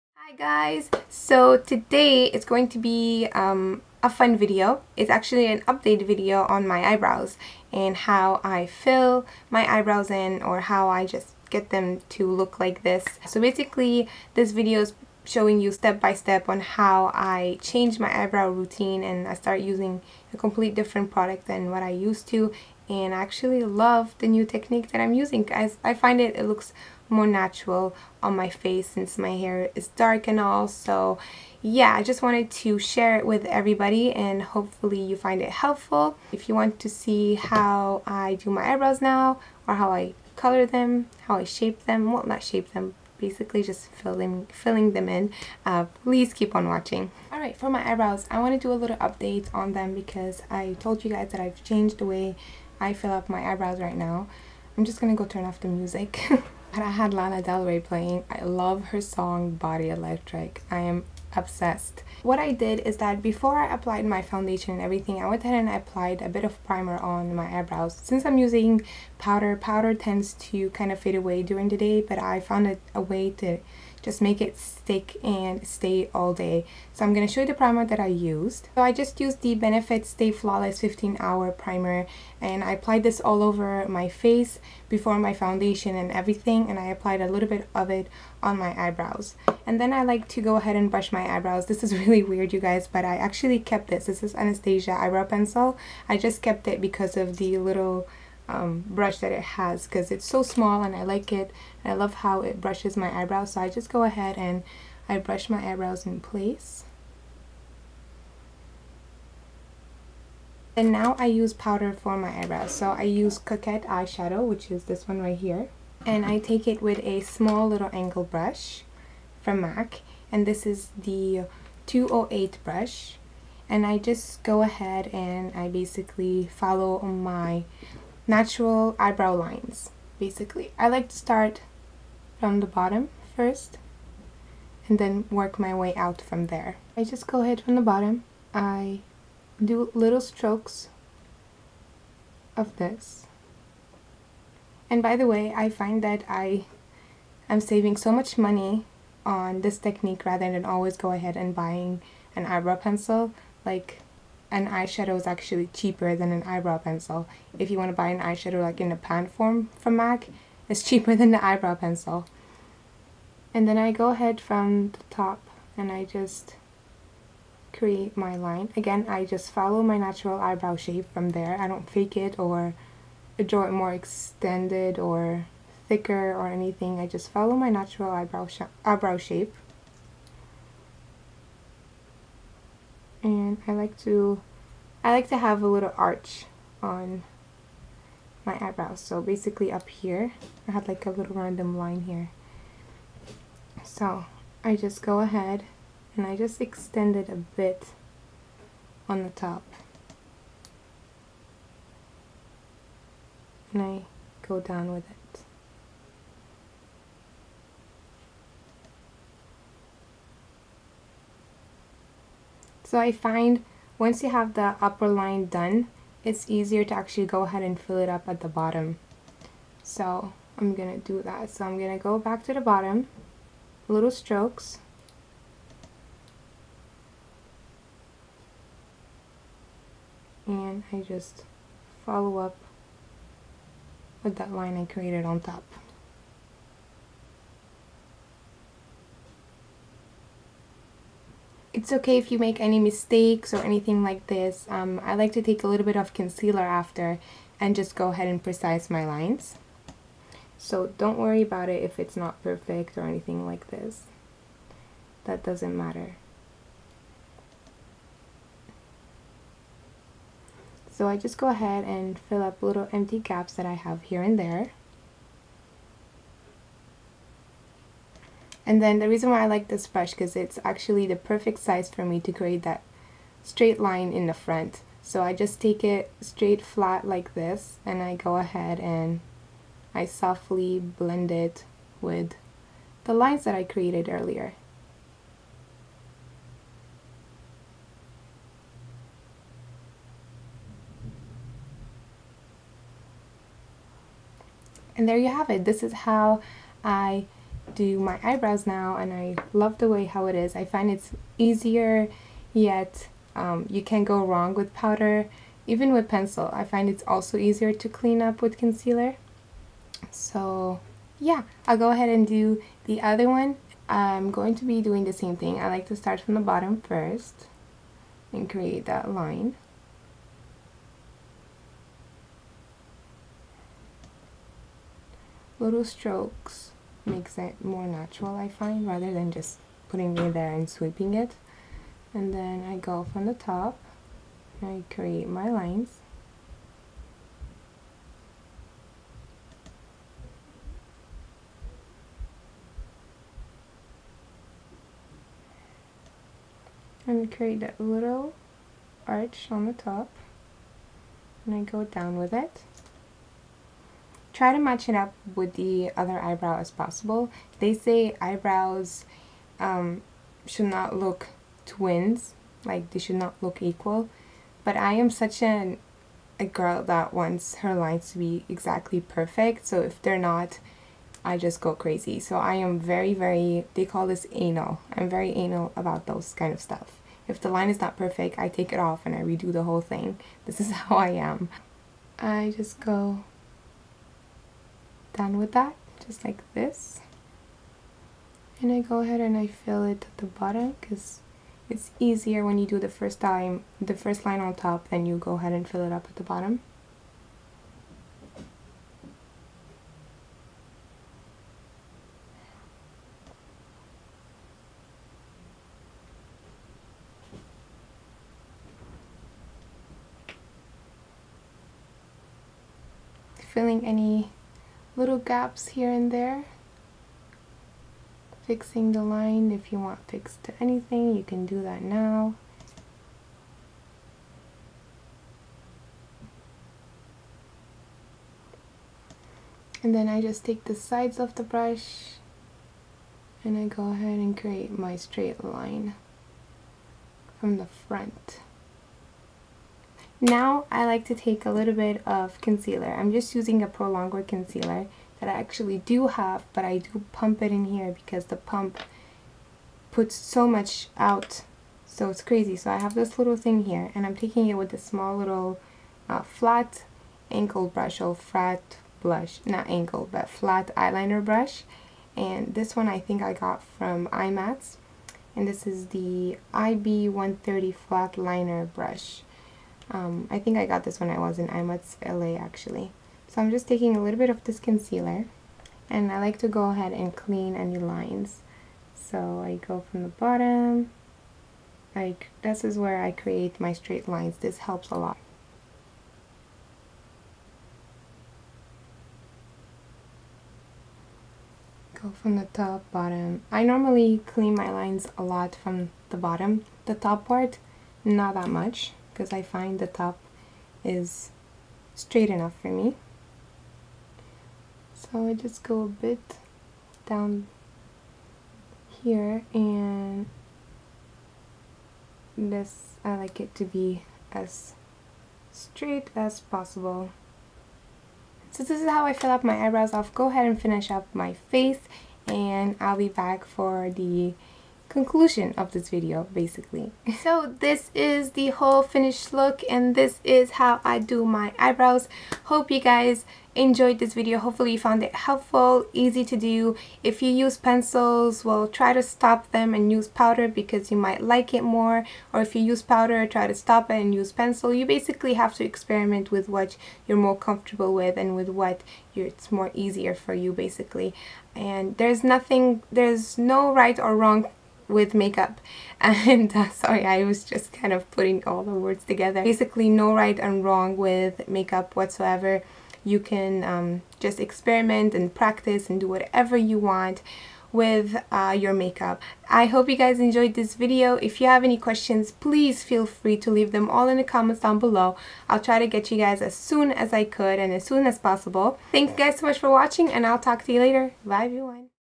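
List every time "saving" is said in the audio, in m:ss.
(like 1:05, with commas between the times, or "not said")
2:27.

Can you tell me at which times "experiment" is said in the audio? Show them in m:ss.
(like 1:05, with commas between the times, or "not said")
9:05, 9:24.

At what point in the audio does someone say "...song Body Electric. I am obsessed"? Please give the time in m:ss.
0:59.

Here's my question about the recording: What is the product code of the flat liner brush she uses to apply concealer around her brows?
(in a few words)
IB130.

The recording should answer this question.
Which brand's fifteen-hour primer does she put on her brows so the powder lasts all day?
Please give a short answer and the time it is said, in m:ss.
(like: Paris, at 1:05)
Benefit, at 1:19.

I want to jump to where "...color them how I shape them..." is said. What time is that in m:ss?
0:40.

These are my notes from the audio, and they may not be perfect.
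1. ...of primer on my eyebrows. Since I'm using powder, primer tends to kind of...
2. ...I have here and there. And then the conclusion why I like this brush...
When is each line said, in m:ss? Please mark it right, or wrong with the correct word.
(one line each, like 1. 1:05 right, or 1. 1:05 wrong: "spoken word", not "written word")
1. 1:06 wrong: "powder", not "primer"
2. 4:23 wrong: "reason", not "conclusion".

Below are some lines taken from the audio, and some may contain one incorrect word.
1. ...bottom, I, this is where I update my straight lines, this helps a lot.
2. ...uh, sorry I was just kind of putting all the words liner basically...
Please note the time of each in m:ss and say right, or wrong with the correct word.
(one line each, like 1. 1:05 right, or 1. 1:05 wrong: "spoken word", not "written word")
1. 8:00 wrong: "create", not "update"
2. 9:16 wrong: "together", not "liner".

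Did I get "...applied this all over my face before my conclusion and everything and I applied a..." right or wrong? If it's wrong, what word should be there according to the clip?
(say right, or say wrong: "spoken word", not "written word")
wrong: "foundation", not "conclusion".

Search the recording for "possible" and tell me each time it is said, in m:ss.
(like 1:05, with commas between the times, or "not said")
5:56, 8:36, 9:38.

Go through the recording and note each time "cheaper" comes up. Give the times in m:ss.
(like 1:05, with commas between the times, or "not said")
2:35, 2:40.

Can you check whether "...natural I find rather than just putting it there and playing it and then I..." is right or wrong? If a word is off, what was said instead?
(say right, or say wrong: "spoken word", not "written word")
wrong: "sweeping", not "playing".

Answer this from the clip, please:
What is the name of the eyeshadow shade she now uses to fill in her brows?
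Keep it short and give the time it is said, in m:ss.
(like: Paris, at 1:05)
Coquette, at 1:53.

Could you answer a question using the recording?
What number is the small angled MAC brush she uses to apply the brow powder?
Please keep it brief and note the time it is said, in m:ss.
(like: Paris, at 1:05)
208, at 2:01.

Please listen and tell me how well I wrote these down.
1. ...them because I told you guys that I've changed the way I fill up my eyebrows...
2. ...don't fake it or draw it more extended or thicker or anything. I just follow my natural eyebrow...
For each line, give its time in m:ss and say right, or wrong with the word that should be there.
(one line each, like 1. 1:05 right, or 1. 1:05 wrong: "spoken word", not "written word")
1. 0:49 right
2. 2:51 right.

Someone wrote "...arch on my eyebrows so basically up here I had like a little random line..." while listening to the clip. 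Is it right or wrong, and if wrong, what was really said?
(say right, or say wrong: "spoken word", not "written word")
right.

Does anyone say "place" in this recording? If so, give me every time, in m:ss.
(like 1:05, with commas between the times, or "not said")
1:46.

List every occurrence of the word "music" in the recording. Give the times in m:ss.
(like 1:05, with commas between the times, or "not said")
0:55.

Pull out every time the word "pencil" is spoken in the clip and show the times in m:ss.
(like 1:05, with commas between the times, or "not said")
1:35, 2:32, 2:36, 2:41, 5:06, 8:57, 9:04.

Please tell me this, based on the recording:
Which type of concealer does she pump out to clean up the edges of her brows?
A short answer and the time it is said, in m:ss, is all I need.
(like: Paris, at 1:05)
Prolongwear, at 7:23.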